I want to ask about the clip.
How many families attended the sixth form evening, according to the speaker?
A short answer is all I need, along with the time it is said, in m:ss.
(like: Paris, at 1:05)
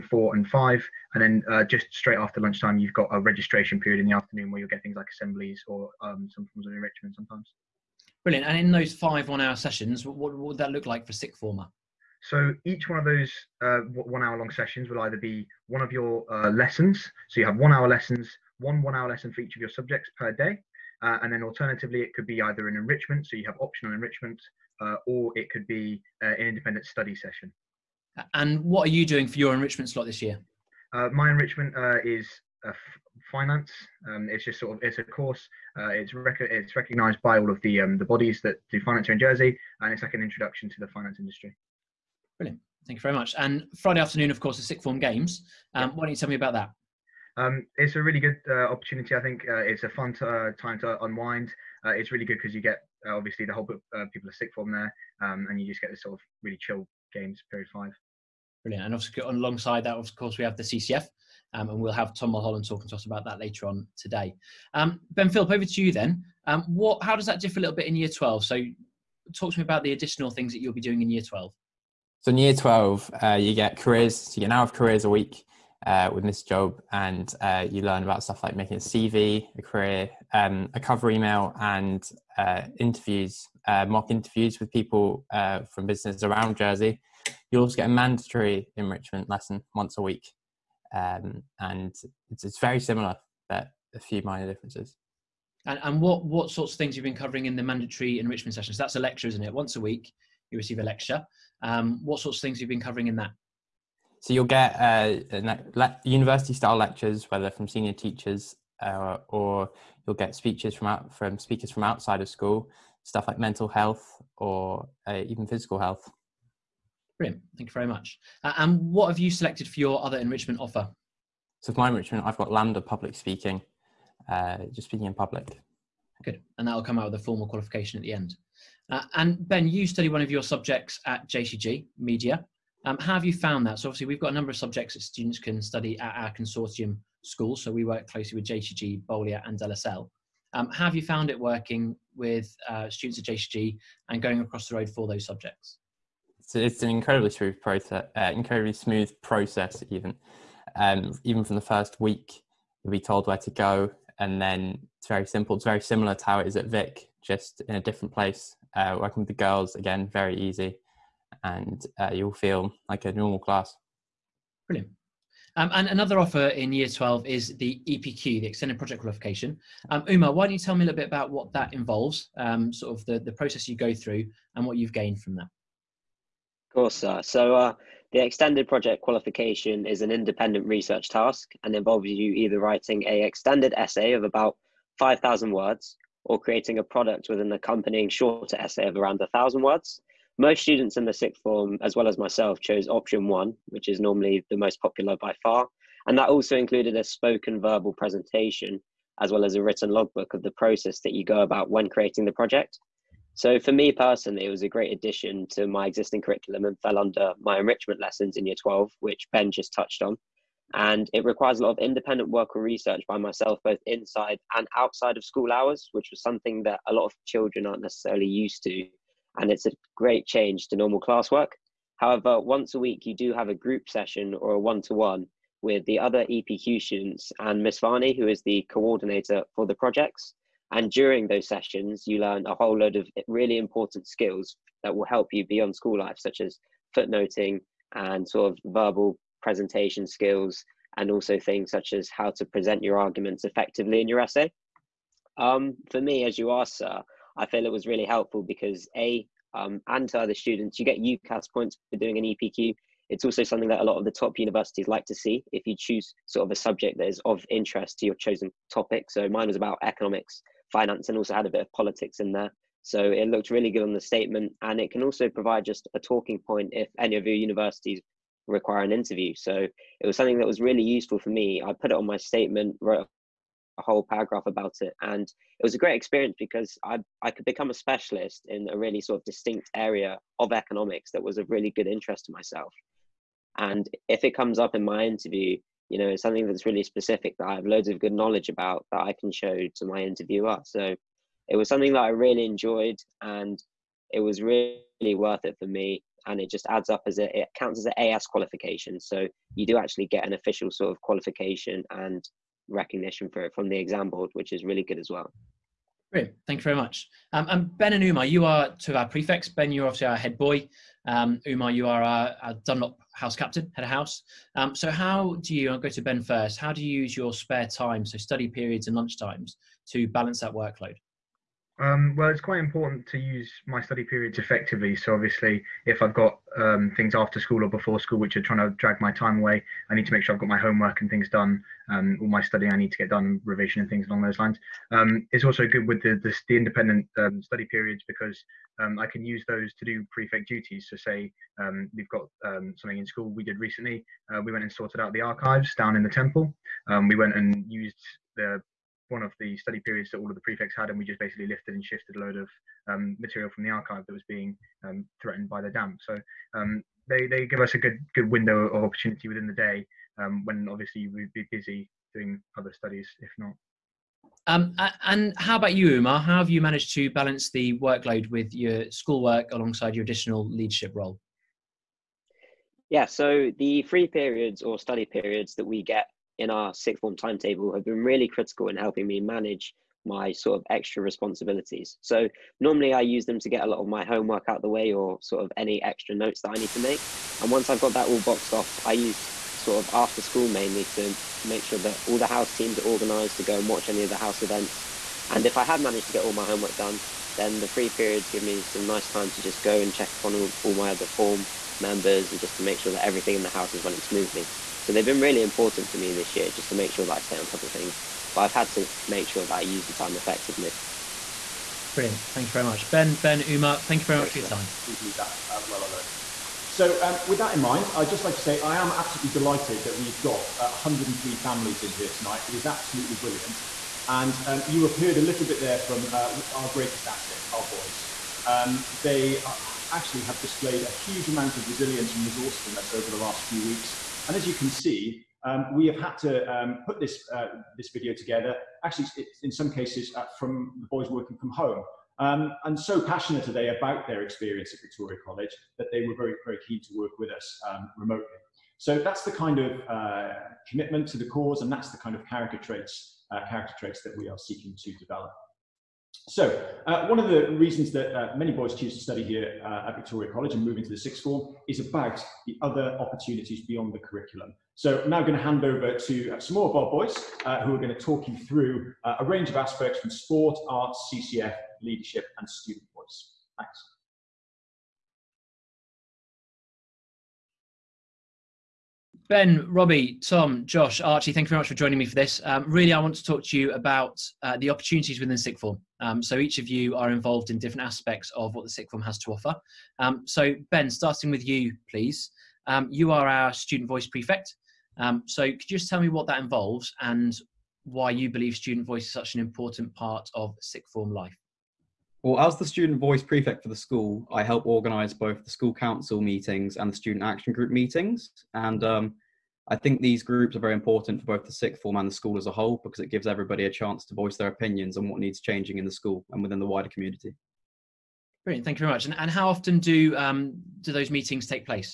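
103, at 7:00.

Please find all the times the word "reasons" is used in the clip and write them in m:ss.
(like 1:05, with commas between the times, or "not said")
7:37.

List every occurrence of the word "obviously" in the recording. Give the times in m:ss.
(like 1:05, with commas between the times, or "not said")
0:53, 2:13, 5:09, 5:25, 6:00.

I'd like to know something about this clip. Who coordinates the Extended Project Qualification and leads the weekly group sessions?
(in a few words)
Miss Varney.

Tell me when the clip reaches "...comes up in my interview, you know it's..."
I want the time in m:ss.
4:44.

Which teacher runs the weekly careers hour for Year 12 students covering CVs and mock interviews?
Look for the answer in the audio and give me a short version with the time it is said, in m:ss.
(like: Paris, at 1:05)
Miss Job, at 1:16.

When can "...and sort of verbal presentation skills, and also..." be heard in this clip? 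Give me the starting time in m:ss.
3:57.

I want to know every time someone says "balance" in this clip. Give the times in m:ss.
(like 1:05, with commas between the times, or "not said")
5:20, 6:07.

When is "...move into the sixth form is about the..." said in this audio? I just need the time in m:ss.
7:40.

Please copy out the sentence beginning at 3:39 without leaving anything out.
And it's a great change to normal classwork.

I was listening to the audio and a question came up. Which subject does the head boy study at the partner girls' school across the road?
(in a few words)
Media.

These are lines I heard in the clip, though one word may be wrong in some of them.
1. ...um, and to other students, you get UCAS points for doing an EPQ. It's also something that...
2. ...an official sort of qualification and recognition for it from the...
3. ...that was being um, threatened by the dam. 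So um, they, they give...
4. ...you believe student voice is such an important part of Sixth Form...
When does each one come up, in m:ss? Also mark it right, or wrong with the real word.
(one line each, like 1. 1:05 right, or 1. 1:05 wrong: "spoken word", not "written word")
1. 4:09 right
2. 5:00 right
3. 5:54 right
4. 8:18 right.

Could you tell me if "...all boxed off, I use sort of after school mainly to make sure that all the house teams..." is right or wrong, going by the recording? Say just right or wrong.
right.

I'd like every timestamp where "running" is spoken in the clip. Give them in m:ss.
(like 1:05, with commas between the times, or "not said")
6:43.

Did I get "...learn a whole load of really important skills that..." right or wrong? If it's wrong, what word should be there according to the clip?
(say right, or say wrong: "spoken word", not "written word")
right.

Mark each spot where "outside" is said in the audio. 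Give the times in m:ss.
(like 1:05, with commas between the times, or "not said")
1:51, 3:34.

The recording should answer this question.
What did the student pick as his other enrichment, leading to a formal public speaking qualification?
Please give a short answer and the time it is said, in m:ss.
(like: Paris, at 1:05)
LAMDA public speaking, at 2:02.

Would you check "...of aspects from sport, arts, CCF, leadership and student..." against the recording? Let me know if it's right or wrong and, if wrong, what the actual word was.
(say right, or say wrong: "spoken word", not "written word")
right.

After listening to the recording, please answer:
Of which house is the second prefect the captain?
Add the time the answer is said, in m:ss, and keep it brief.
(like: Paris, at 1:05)
Dunlop, at 5:12.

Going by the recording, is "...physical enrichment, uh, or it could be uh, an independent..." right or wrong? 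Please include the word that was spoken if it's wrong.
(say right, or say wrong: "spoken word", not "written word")
wrong: "optional", not "physical".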